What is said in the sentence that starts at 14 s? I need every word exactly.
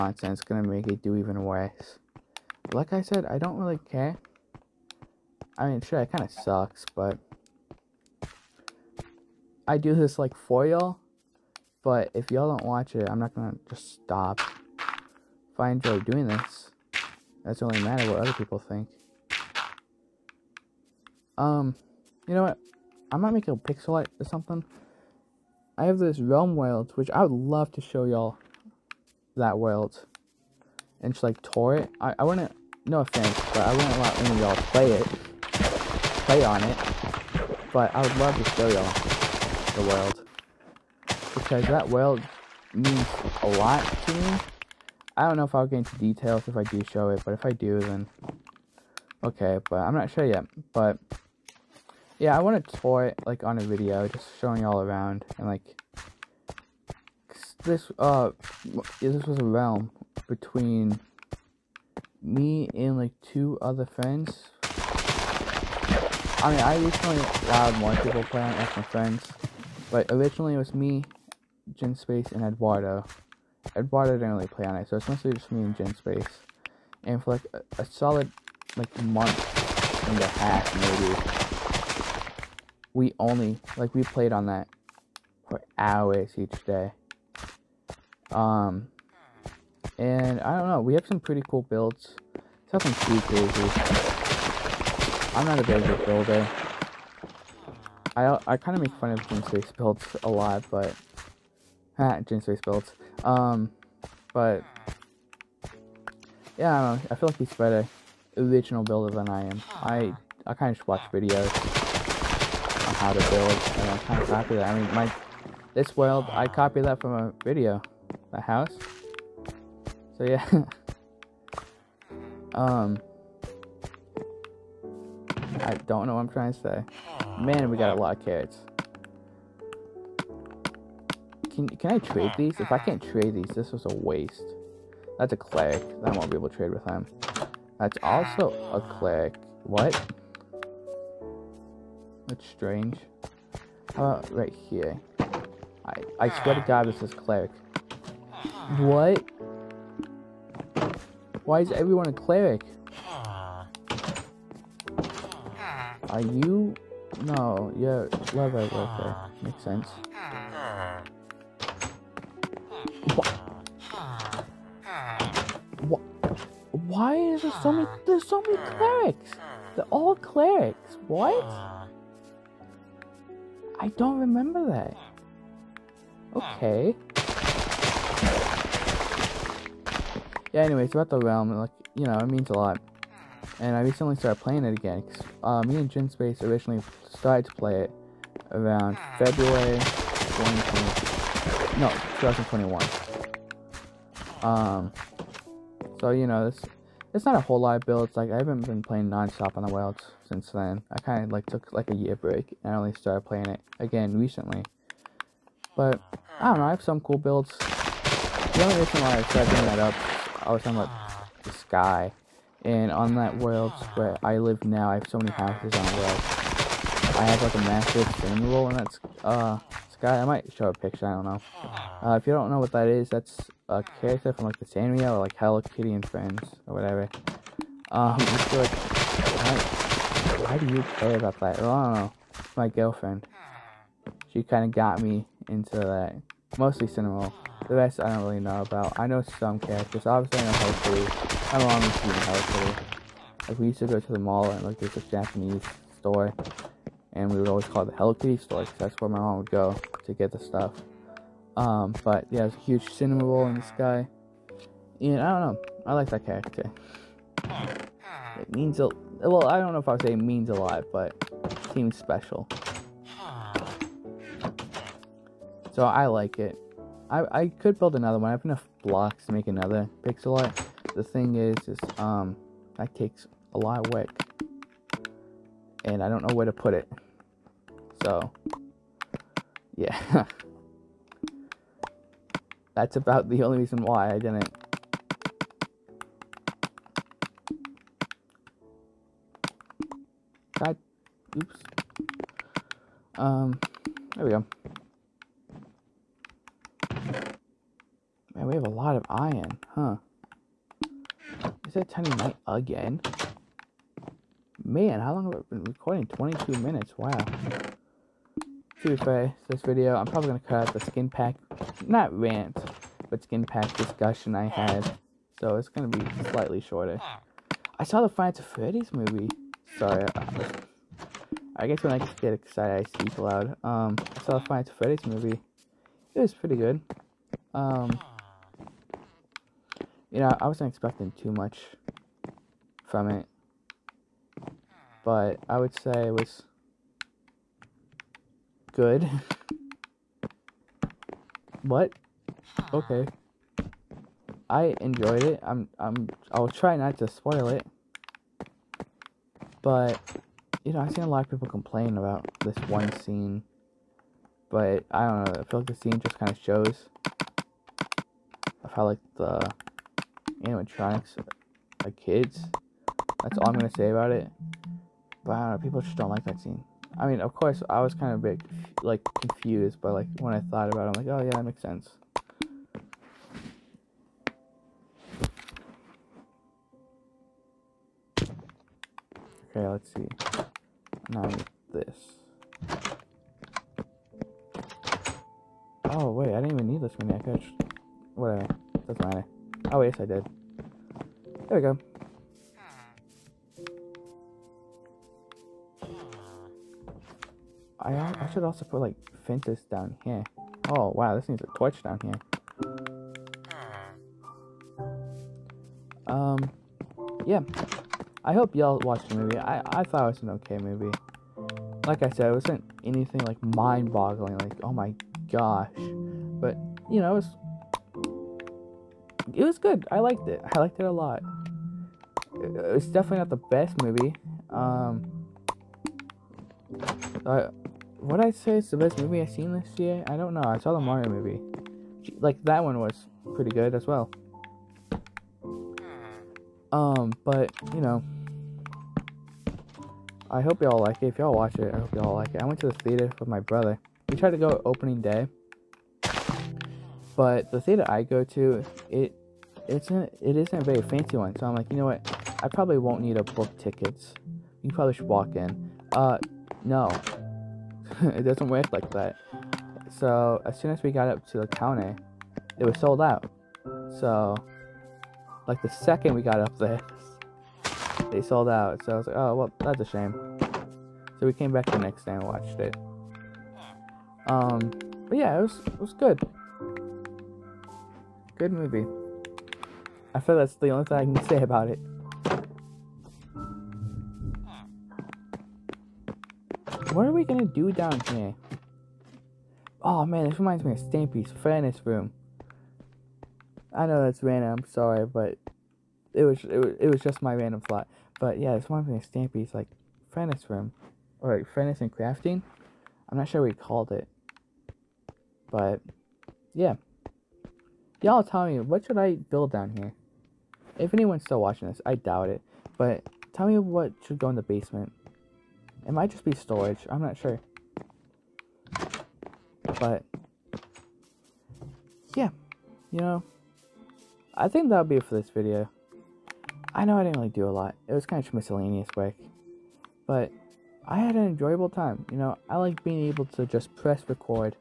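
If I enjoy doing this, that's only matter what other people think.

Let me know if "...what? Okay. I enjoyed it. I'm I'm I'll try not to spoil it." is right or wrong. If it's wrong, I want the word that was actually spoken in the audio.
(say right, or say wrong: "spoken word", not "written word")
right.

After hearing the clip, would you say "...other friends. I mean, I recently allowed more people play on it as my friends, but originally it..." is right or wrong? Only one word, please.
right.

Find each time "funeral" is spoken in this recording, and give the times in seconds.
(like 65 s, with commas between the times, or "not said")
218 s.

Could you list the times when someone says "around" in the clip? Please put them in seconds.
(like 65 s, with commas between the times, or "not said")
54 s, 188 s.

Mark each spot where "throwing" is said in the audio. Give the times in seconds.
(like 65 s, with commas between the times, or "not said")
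not said.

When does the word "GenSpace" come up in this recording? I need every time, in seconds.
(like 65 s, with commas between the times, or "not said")
71 s, 75 s, 185 s.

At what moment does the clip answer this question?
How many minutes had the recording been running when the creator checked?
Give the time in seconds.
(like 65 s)
306 s.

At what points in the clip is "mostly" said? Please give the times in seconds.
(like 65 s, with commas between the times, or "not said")
75 s, 236 s.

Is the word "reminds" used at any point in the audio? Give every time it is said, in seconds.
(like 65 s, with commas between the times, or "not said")
490 s, 498 s.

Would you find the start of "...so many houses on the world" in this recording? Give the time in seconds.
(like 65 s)
215 s.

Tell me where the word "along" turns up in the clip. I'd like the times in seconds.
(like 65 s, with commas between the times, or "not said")
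not said.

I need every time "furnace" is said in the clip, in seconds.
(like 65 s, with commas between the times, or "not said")
491 s, 500 s.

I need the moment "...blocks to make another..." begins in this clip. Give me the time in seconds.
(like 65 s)
268 s.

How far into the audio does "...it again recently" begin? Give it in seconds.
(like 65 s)
203 s.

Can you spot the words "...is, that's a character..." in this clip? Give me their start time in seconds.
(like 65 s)
222 s.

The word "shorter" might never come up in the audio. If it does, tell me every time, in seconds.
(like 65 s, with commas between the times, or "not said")
316 s.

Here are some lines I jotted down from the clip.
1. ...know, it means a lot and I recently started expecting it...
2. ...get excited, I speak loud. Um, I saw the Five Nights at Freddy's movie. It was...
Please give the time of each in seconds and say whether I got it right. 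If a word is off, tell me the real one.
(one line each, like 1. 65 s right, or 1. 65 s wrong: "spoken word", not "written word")
1. 182 s wrong: "playing", not "expecting"
2. 322 s right.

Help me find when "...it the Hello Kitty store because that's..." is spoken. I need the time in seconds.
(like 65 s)
247 s.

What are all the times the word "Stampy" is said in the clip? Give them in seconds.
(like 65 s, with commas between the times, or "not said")
490 s, 499 s.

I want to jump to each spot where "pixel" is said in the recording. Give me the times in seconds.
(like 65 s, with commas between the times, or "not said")
23 s, 270 s.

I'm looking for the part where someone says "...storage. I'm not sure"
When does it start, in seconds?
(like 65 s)
516 s.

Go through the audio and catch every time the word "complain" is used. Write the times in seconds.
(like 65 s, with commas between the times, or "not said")
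351 s.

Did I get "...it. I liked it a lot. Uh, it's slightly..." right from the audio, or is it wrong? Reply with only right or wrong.
wrong.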